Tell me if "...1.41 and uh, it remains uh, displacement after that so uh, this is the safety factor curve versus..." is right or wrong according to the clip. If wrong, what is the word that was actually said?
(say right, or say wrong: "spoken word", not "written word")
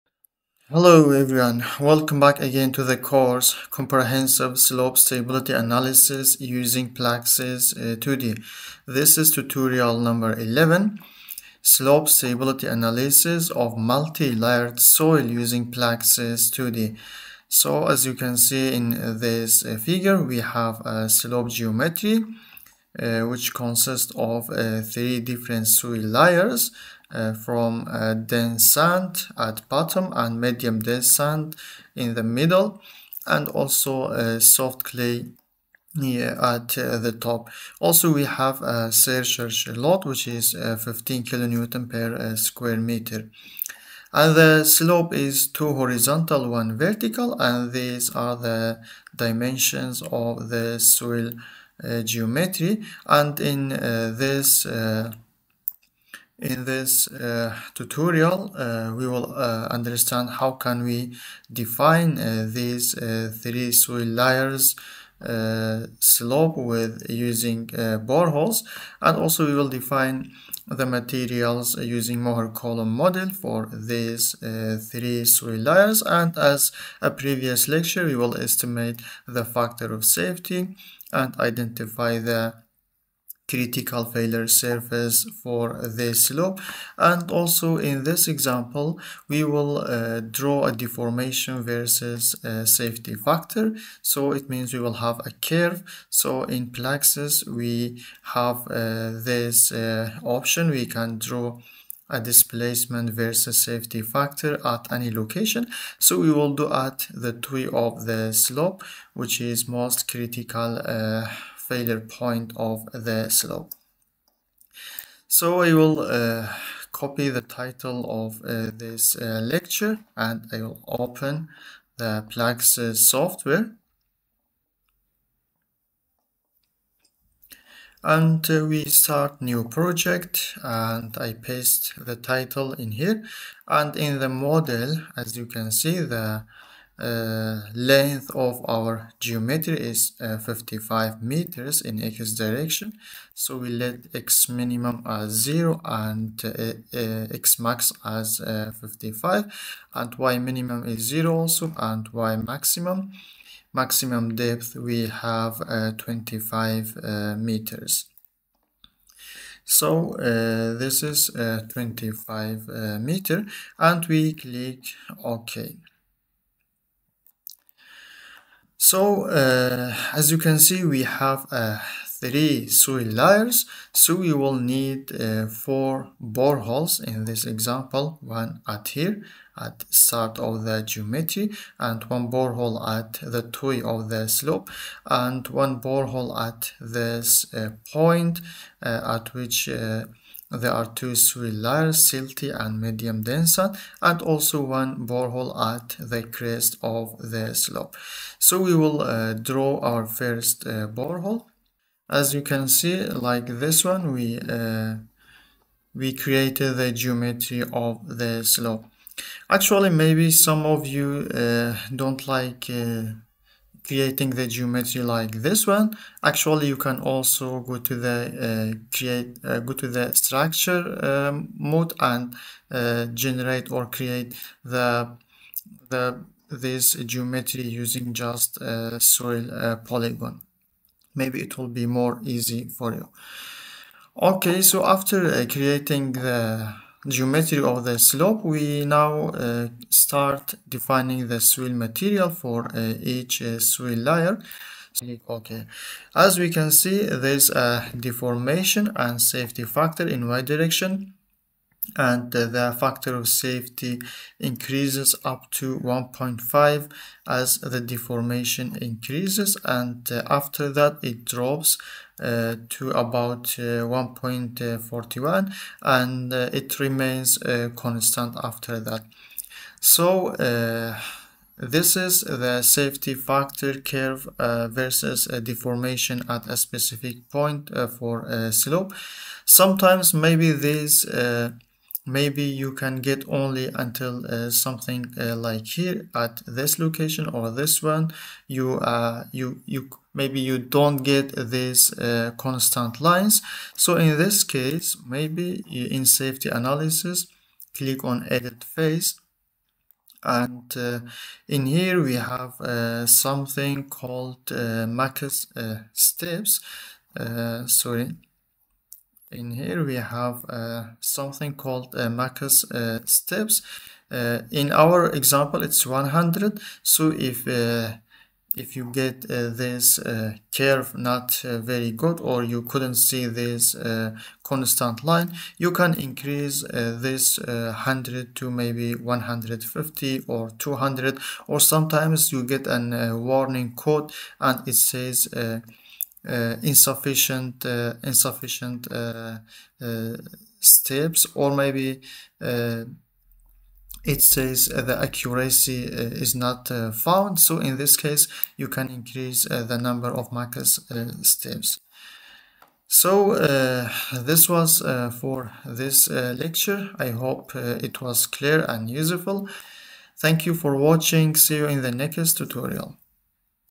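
wrong: "constant", not "displacement".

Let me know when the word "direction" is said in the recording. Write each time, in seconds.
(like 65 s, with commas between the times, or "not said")
142 s, 250 s.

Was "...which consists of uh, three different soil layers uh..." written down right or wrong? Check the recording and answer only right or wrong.
right.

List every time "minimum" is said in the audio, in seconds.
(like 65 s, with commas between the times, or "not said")
144 s, 150 s.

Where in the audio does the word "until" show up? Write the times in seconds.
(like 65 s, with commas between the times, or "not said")
283 s.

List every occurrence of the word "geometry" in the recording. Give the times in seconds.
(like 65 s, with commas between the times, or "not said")
21 s, 52 s, 139 s, 180 s, 206 s, 214 s, 227 s, 237 s.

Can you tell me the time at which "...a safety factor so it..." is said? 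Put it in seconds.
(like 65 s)
92 s.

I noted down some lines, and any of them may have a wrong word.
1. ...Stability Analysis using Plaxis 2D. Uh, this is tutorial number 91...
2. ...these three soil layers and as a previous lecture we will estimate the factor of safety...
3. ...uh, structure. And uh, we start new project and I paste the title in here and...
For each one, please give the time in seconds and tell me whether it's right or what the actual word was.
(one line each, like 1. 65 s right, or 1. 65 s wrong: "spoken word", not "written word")
1. 4 s wrong: "11", not "91"
2. 73 s right
3. 122 s wrong: "software", not "structure".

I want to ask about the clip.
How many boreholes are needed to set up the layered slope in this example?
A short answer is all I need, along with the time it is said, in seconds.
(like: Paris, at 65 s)
4, at 175 s.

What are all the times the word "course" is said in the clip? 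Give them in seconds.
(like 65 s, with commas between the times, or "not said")
2 s.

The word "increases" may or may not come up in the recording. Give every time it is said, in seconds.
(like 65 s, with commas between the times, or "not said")
254 s, 258 s, 325 s, 348 s.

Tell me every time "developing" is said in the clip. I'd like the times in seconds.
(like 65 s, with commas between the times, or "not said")
not said.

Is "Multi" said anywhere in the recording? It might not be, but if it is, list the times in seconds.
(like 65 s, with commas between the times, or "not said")
13 s.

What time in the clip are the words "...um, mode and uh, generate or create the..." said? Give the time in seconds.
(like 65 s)
221 s.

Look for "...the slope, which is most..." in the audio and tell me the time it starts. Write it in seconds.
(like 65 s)
108 s.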